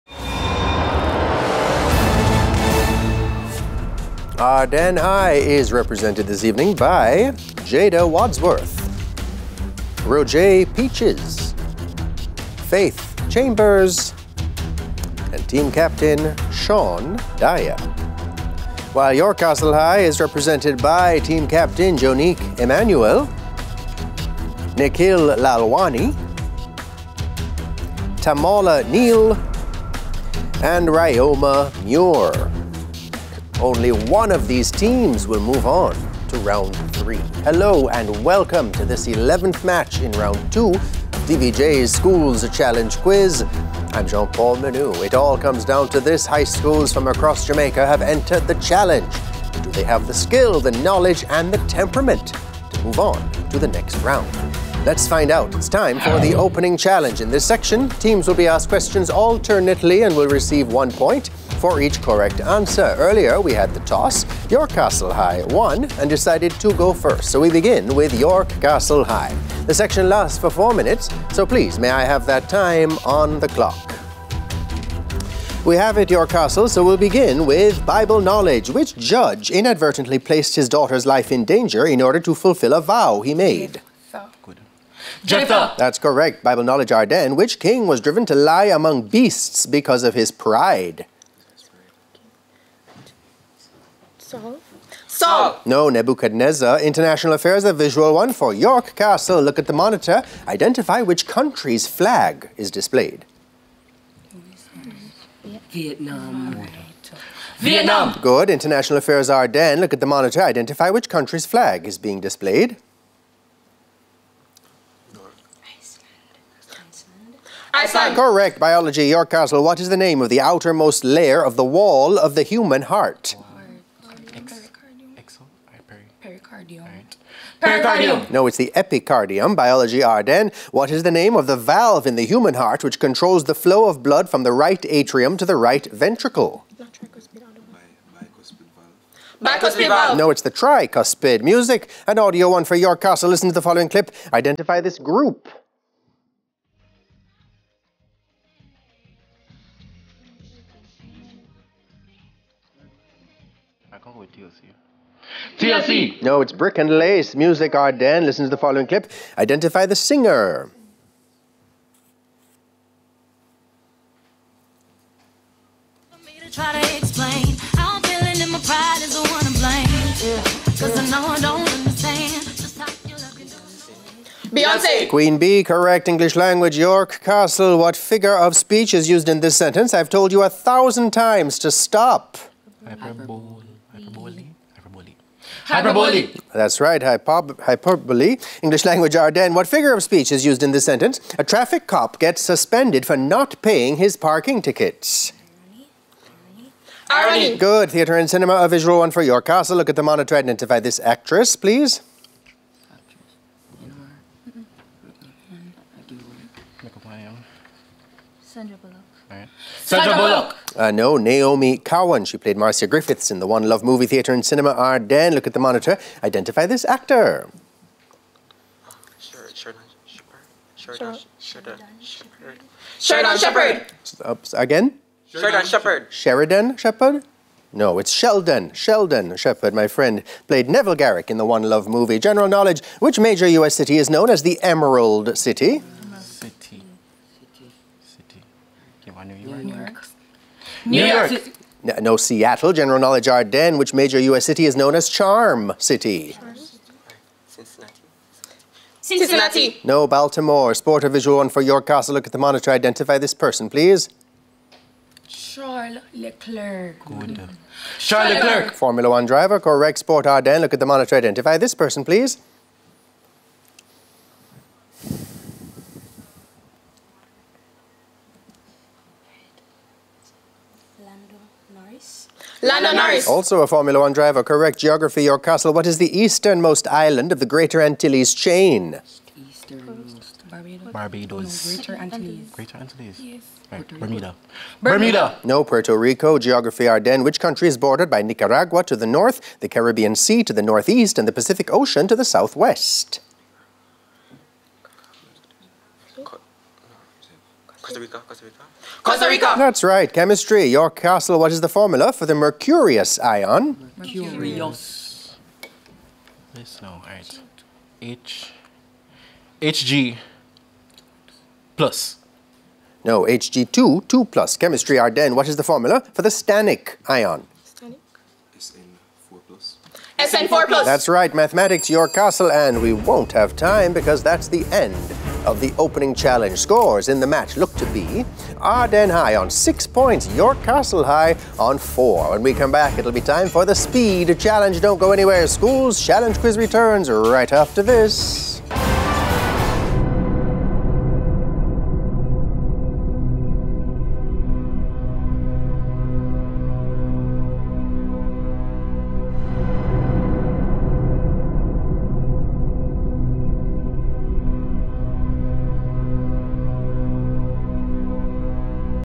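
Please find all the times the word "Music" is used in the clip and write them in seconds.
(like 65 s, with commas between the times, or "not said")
141 s, 157 s.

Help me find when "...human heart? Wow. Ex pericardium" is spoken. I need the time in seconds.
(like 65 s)
122 s.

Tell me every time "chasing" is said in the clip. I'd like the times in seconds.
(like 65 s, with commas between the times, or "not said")
not said.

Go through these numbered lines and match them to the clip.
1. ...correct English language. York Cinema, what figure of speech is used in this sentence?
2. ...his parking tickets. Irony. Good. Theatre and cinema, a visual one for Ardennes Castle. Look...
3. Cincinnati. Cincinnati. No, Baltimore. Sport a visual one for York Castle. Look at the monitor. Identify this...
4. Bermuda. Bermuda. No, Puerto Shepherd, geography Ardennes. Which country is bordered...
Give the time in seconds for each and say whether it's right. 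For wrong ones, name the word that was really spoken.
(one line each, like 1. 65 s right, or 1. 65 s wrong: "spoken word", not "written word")
1. 175 s wrong: "Castle", not "Cinema"
2. 193 s wrong: "York", not "Ardennes"
3. 247 s right
4. 283 s wrong: "Rico", not "Shepherd".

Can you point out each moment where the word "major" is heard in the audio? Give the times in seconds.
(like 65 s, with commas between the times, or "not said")
233 s, 243 s.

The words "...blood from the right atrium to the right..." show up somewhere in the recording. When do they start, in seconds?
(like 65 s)
134 s.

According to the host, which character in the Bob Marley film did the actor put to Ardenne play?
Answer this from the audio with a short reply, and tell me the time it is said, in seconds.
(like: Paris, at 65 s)
Neville Garrick, at 230 s.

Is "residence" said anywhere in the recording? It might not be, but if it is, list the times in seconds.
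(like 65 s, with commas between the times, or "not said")
not said.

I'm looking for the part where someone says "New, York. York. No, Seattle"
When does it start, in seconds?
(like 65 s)
240 s.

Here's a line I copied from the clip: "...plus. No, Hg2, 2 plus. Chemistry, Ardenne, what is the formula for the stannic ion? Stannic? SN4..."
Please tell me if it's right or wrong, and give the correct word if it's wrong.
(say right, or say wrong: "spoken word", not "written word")
right.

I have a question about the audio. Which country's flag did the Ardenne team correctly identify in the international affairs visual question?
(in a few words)
Iceland.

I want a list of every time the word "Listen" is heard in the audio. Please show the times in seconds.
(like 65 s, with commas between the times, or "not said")
143 s, 158 s.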